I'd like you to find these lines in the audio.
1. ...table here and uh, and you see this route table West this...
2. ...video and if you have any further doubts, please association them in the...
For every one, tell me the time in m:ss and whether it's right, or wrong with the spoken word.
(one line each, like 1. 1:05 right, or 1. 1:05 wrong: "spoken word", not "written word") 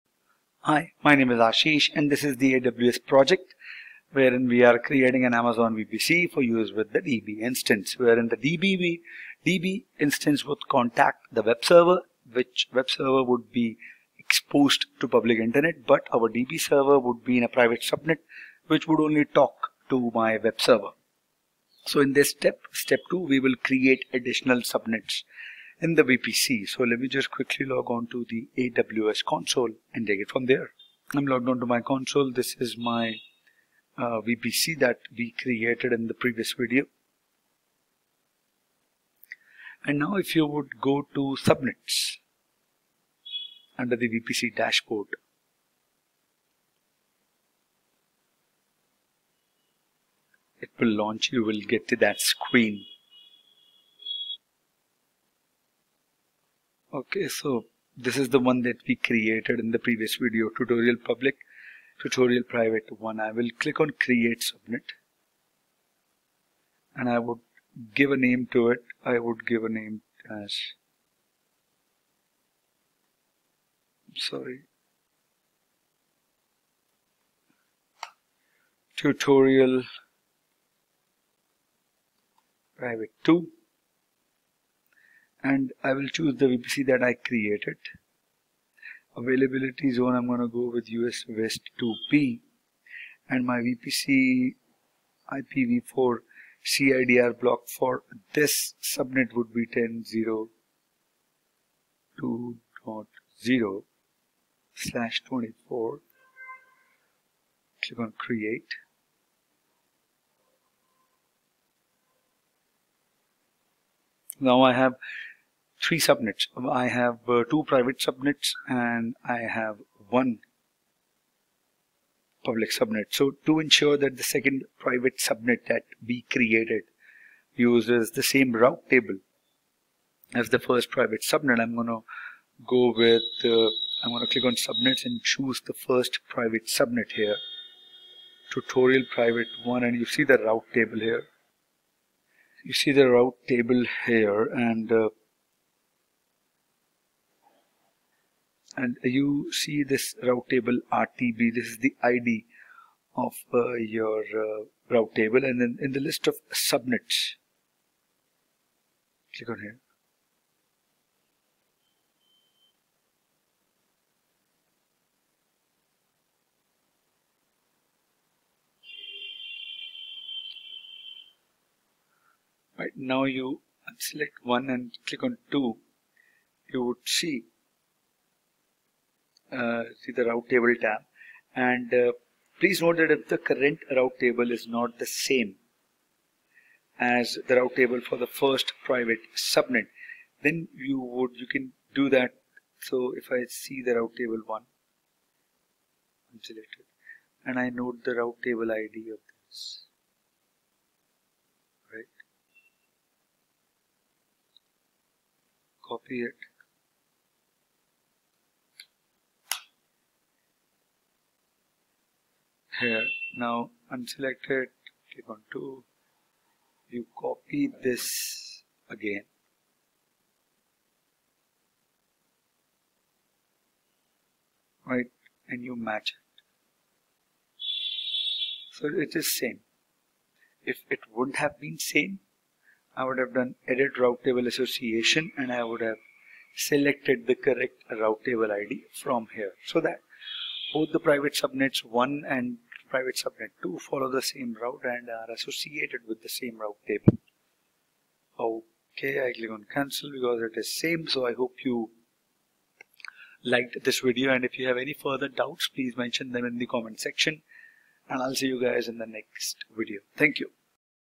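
1. 2:23 wrong: "RTB", not "West"
2. 4:14 wrong: "mention", not "association".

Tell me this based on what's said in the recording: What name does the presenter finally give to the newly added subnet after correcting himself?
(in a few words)
tutorial private 2.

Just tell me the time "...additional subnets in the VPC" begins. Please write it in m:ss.
0:24.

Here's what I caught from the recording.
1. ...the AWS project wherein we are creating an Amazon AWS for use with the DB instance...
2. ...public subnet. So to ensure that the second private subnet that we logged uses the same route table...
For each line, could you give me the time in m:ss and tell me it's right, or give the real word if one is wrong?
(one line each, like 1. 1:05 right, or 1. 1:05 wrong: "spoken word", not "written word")
1. 0:02 wrong: "VPC", not "AWS"
2. 2:02 wrong: "created", not "logged".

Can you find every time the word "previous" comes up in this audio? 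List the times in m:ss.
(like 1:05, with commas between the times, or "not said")
0:36, 0:59.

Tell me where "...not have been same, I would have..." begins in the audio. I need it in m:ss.
3:51.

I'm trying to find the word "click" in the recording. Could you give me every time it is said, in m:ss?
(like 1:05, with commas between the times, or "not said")
1:03, 1:47, 2:14, 2:39, 2:55, 3:35, 4:09.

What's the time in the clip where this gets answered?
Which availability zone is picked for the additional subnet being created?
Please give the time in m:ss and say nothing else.
1:30.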